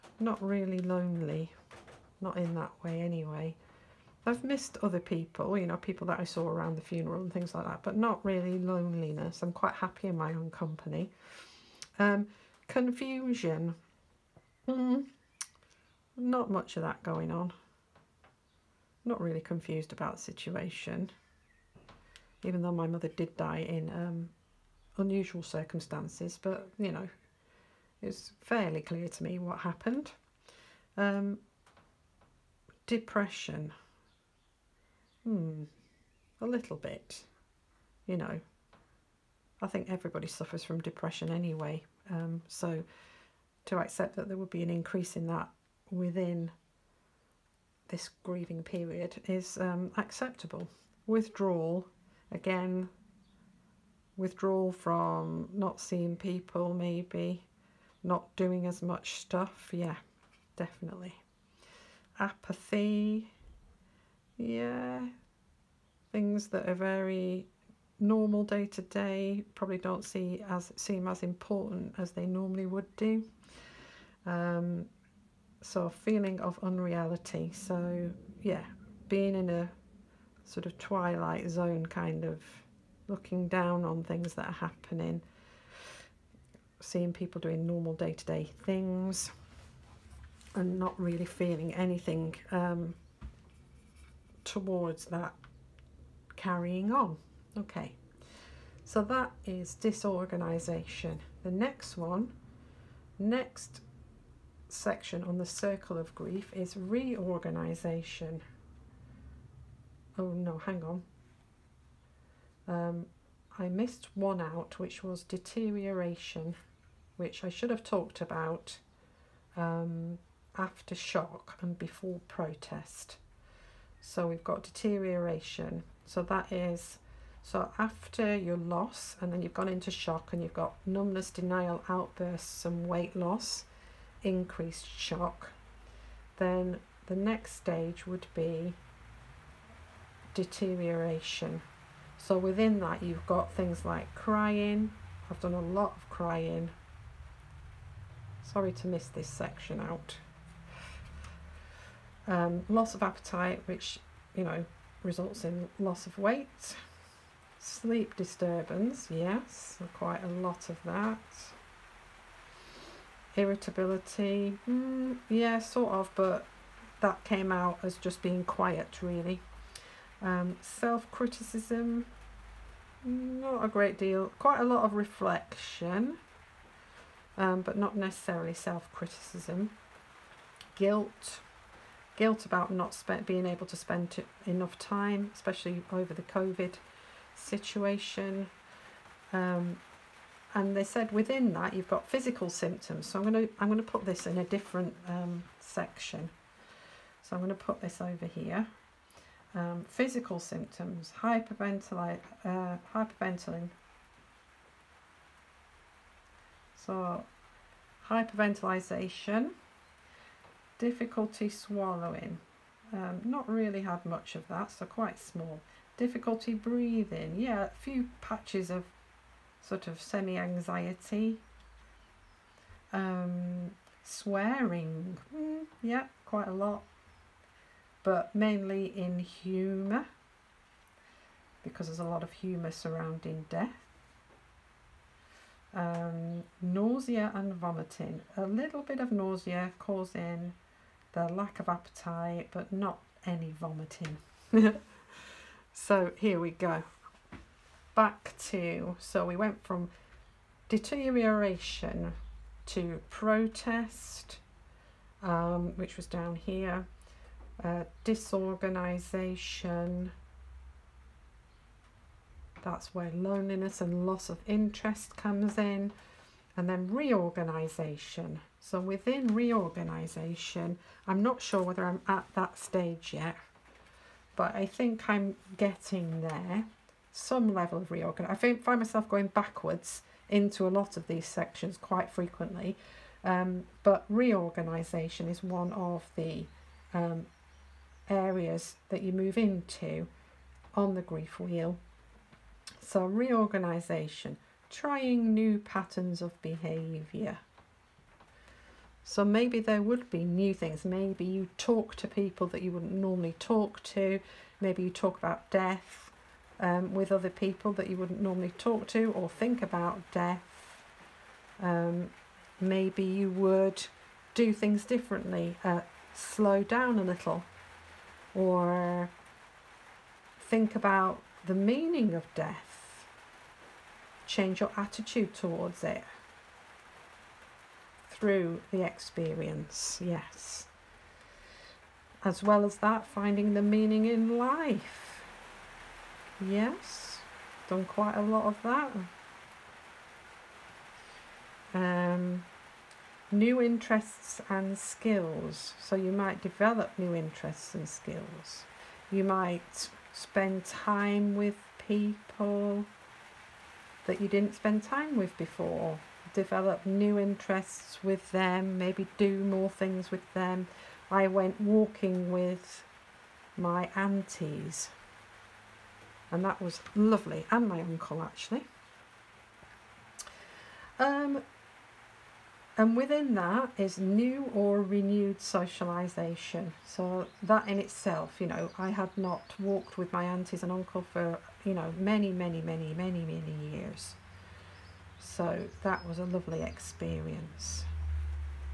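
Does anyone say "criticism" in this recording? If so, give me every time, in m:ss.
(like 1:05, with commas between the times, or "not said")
2:50, 2:58.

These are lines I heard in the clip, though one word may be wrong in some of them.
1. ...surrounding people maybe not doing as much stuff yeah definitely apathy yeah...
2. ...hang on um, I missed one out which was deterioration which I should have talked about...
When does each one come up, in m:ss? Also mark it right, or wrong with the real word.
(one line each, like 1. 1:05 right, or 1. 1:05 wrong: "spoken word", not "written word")
1. 0:55 wrong: "seeing", not "surrounding"
2. 1:50 right.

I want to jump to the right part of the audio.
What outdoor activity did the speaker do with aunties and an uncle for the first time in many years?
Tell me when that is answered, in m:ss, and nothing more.
6:01.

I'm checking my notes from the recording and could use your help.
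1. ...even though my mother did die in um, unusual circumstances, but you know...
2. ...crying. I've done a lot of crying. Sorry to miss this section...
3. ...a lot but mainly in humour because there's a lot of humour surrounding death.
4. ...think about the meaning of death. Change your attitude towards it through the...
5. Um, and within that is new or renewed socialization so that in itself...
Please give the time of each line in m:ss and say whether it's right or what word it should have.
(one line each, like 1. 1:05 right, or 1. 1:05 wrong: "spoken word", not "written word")
1. 0:22 right
2. 2:24 right
3. 3:46 right
4. 5:20 right
5. 6:10 right.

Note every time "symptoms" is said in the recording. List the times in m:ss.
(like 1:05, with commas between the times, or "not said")
3:12, 3:20.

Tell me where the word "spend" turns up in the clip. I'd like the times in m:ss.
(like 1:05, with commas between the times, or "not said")
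3:03, 5:50, 5:54.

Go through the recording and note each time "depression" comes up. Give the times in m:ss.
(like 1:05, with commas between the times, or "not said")
0:32, 0:40.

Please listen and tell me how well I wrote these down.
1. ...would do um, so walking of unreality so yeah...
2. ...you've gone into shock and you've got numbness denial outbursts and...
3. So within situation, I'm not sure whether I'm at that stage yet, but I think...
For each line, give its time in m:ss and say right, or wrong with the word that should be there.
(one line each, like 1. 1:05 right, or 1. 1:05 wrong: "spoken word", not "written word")
1. 1:12 wrong: "feeling", not "walking"
2. 2:09 right
3. 4:28 wrong: "reorganization", not "situation".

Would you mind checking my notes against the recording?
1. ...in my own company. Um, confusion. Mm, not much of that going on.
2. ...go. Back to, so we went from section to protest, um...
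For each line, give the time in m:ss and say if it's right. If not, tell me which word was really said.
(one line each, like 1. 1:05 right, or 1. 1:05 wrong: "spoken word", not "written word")
1. 0:10 right
2. 4:06 wrong: "deterioration", not "section".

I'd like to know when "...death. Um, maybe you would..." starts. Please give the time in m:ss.
5:10.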